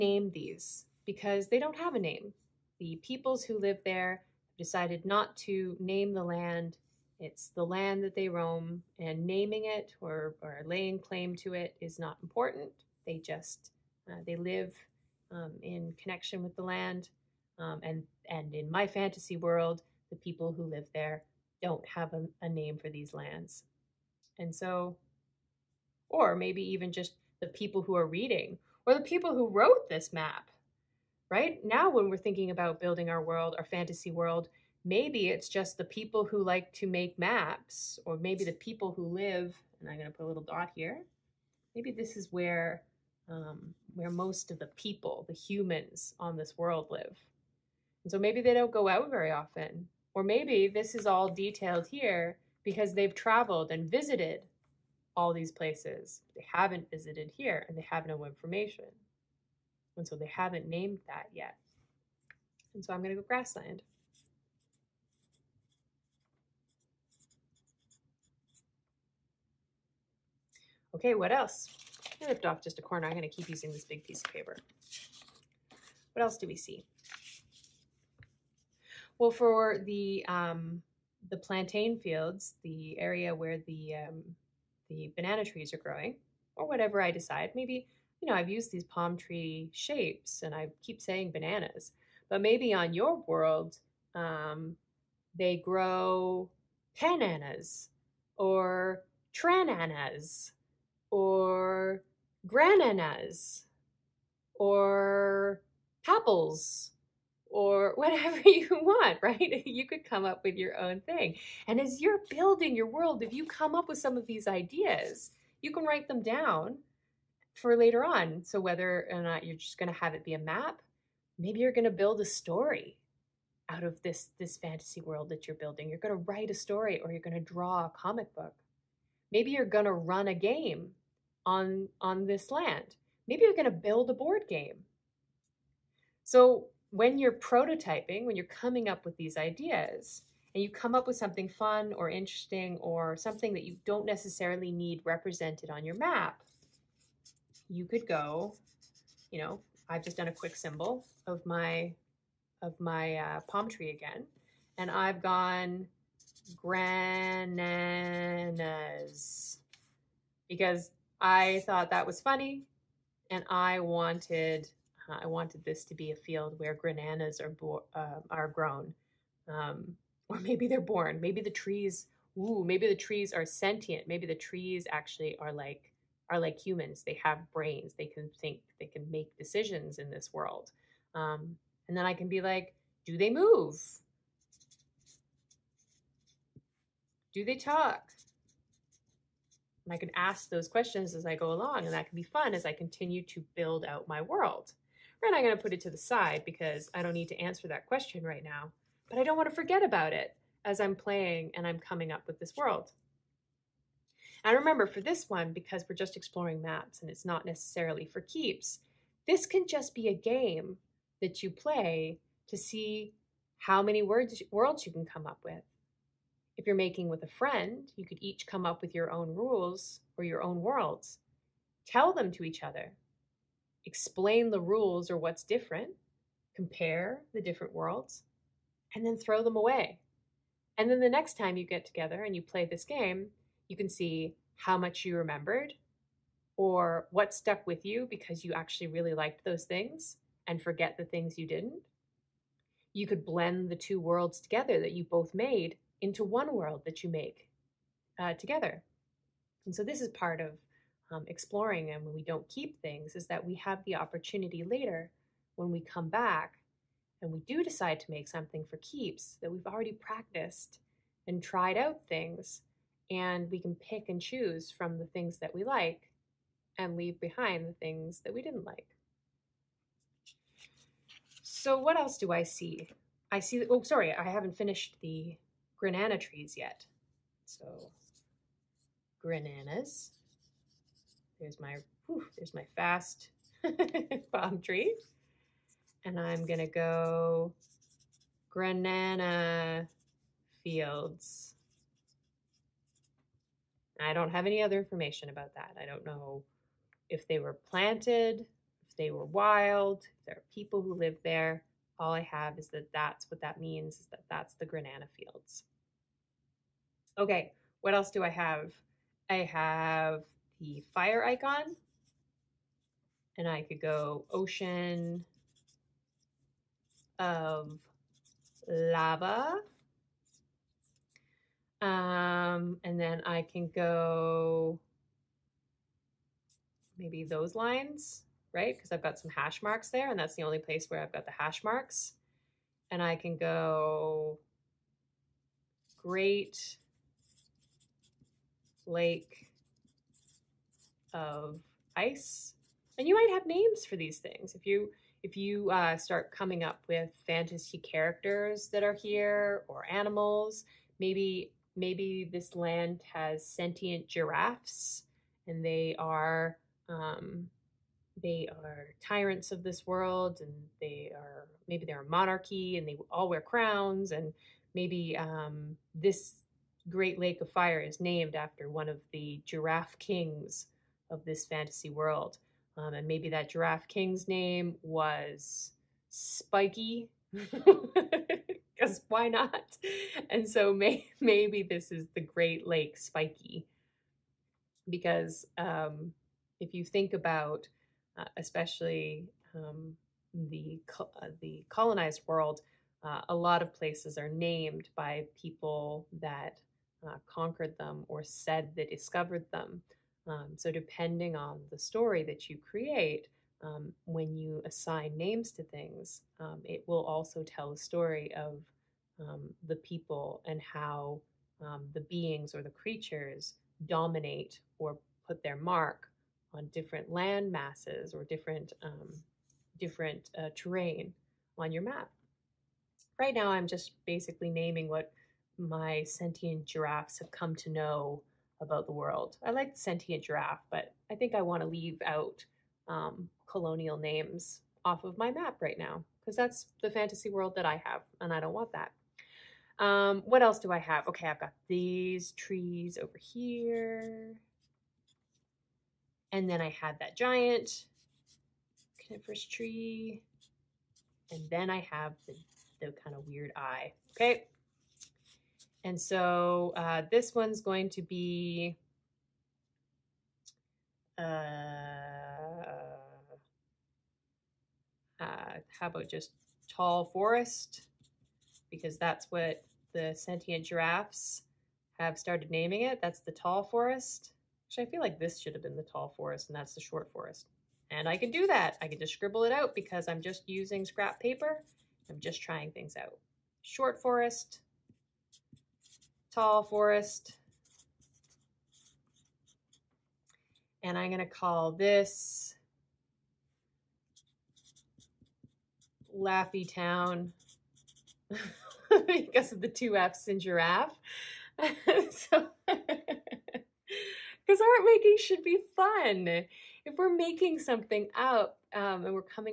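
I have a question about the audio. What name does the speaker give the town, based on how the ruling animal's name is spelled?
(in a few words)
Laffy Town.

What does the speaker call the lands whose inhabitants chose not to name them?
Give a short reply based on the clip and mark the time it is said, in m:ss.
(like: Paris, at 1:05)
grassland, at 1:03.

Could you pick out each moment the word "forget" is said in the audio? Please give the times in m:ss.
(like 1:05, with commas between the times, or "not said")
3:19, 4:00.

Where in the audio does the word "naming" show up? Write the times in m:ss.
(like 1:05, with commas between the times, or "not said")
0:09, 7:04, 7:52.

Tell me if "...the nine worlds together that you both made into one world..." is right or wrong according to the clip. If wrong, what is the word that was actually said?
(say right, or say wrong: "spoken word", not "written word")
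wrong: "two", not "nine".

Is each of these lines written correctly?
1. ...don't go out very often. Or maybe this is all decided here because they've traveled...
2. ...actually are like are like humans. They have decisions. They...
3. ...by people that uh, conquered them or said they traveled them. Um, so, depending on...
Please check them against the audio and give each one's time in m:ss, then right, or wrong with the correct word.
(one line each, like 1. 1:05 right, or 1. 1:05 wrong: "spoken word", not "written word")
1. 0:48 wrong: "detailed", not "decided"
2. 2:54 wrong: "brains", not "decisions"
3. 6:34 wrong: "discovered", not "traveled".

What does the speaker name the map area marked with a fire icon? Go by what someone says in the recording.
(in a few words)
Ocean of Lava.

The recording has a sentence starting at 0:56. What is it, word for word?
They haven't visited here and they have no information.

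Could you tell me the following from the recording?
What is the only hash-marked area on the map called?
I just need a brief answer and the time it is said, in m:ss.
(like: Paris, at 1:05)
Great Lake of Ice, at 5:36.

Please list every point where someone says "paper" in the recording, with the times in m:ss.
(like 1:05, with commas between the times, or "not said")
1:14, 8:01.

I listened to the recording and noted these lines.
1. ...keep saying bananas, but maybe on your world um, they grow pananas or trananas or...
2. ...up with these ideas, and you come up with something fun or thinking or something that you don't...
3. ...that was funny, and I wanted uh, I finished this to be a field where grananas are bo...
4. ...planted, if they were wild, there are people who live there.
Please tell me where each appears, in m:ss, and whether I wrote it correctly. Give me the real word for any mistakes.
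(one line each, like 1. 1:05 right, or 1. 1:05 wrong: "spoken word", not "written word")
1. 1:30 right
2. 2:18 wrong: "interesting", not "thinking"
3. 2:41 wrong: "wanted", not "finished"
4. 4:57 right.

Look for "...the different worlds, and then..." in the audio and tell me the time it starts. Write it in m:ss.
3:47.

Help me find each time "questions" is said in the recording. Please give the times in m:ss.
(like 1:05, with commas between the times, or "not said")
3:10, 3:17.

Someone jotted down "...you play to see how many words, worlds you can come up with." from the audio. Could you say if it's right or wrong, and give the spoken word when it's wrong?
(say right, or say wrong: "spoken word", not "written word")
right.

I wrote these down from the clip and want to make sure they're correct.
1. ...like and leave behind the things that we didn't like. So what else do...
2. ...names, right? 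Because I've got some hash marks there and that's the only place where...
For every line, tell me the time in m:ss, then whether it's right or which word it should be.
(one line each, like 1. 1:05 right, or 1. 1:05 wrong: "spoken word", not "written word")
1. 4:25 right
2. 5:27 wrong: "lines", not "names".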